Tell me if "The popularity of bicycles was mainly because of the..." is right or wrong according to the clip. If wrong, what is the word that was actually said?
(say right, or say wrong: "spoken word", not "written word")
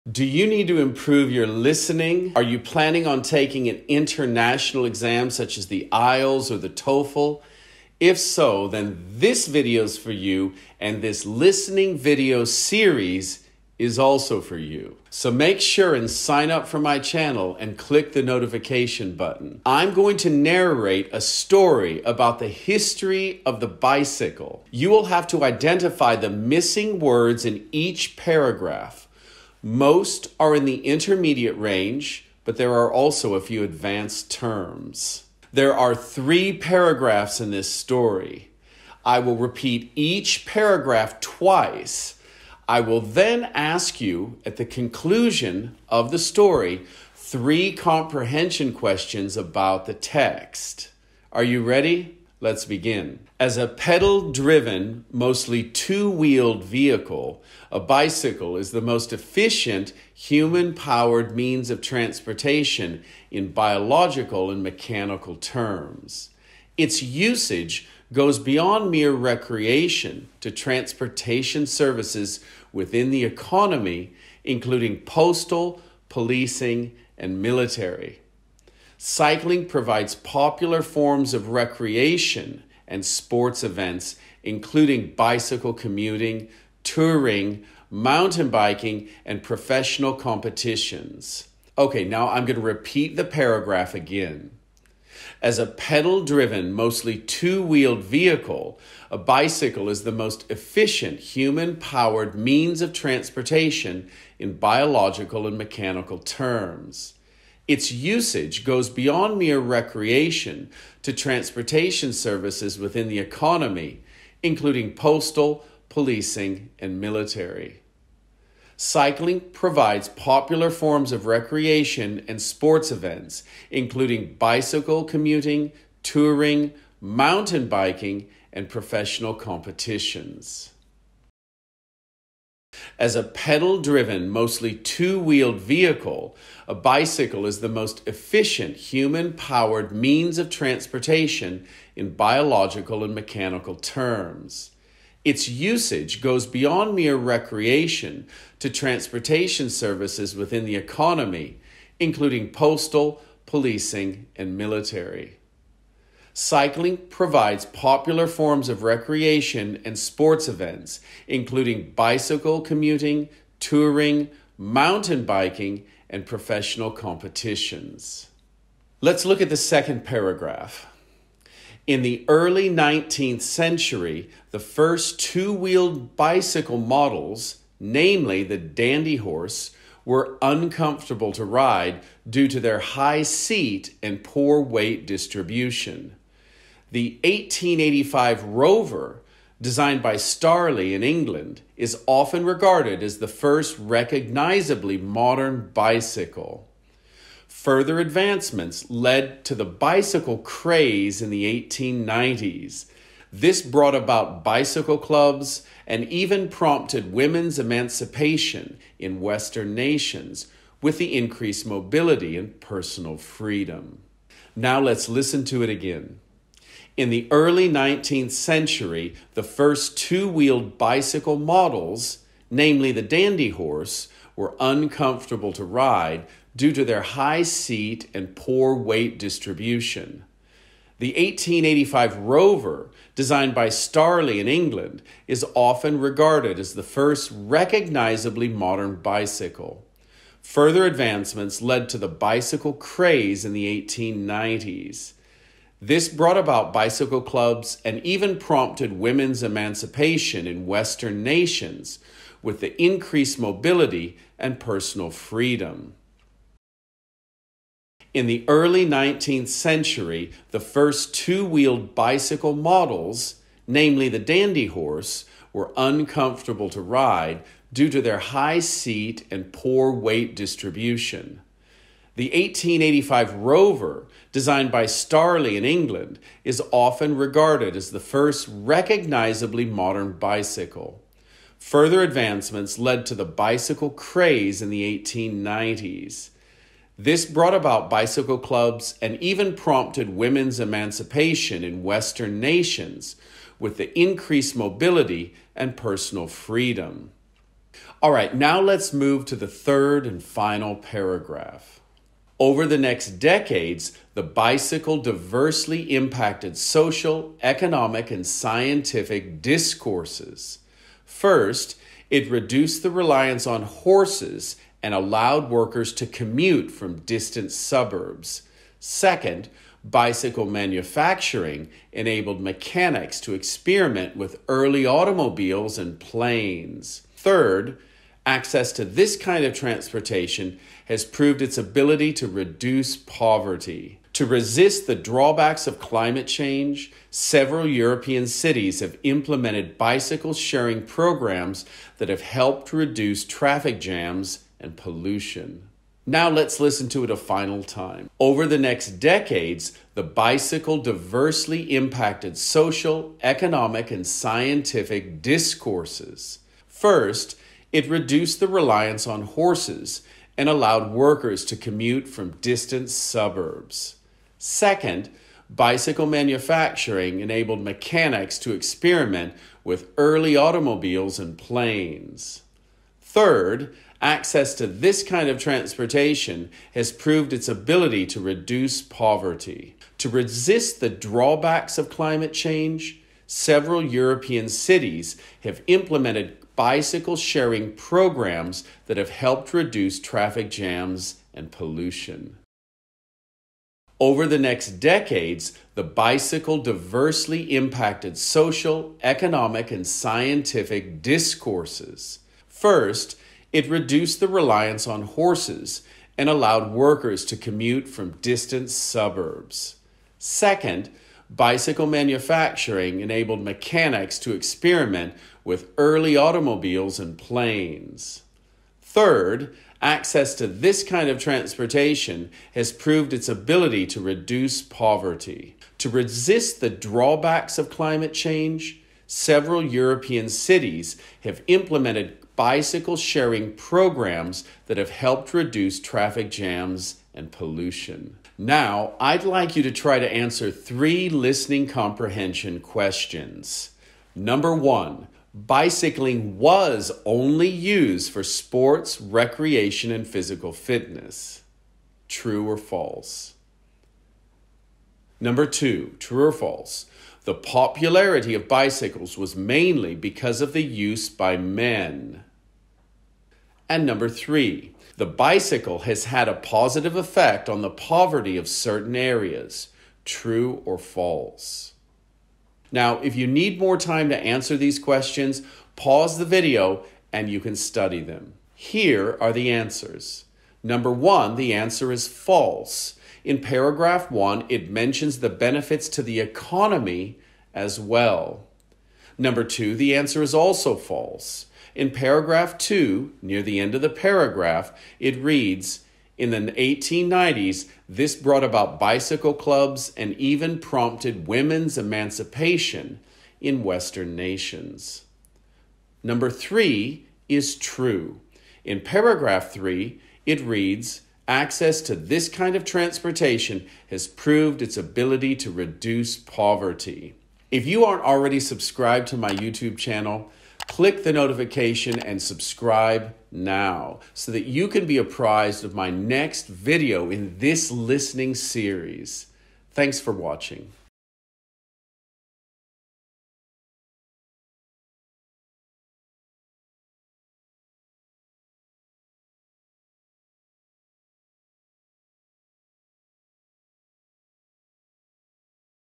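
right.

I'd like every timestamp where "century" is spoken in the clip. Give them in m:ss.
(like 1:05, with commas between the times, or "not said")
2:53, 3:38, 4:19.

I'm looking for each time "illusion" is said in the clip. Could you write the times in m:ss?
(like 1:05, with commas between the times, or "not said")
not said.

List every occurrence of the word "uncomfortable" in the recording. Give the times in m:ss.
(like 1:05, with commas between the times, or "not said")
3:00, 3:44, 4:25.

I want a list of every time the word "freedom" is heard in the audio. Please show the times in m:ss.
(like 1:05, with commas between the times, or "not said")
3:33, 4:15, 4:56.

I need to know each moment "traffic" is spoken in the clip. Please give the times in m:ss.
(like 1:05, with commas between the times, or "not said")
5:43, 6:29, 7:15.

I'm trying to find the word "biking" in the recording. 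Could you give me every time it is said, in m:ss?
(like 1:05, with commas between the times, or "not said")
1:28, 2:07, 2:45.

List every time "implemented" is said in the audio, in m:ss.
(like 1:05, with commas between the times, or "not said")
5:39, 6:25, 7:11.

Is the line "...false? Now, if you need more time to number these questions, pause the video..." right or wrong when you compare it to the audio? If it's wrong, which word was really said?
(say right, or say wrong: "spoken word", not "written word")
wrong: "answer", not "number".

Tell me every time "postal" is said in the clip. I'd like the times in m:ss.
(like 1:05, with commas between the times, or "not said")
1:15, 1:54, 2:32.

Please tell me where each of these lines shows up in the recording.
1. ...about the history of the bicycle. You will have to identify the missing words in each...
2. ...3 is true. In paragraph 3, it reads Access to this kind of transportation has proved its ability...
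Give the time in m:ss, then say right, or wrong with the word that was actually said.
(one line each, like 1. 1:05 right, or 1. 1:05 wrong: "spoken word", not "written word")
1. 0:22 right
2. 8:26 right.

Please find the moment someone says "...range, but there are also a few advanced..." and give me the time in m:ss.
0:31.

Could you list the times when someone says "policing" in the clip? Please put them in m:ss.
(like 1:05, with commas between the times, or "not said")
1:16, 1:55, 2:33.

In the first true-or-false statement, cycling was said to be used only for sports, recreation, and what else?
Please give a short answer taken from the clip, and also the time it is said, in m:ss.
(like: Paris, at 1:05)
physical fitness, at 7:30.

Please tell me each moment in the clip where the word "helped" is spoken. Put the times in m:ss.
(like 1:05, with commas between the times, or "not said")
5:42, 6:29, 7:14.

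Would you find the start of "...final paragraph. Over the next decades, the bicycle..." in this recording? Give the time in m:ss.
5:00.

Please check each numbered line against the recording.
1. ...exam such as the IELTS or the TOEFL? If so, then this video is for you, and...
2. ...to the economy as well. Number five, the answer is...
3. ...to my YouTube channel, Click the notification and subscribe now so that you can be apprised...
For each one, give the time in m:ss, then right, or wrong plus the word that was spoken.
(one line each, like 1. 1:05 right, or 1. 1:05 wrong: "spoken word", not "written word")
1. 0:04 right
2. 8:05 wrong: "two", not "five"
3. 8:39 right.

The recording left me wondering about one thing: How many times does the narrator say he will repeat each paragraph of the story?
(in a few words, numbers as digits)
twice.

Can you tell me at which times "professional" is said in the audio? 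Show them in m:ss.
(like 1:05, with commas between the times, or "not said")
1:29, 2:08, 2:46.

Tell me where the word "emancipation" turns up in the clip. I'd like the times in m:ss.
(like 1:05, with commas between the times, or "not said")
3:27, 4:09, 4:50, 8:21.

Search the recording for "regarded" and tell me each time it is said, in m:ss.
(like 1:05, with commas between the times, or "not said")
3:12, 3:55, 4:37.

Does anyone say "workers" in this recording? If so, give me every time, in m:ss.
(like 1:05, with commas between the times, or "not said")
5:15, 6:00, 6:46.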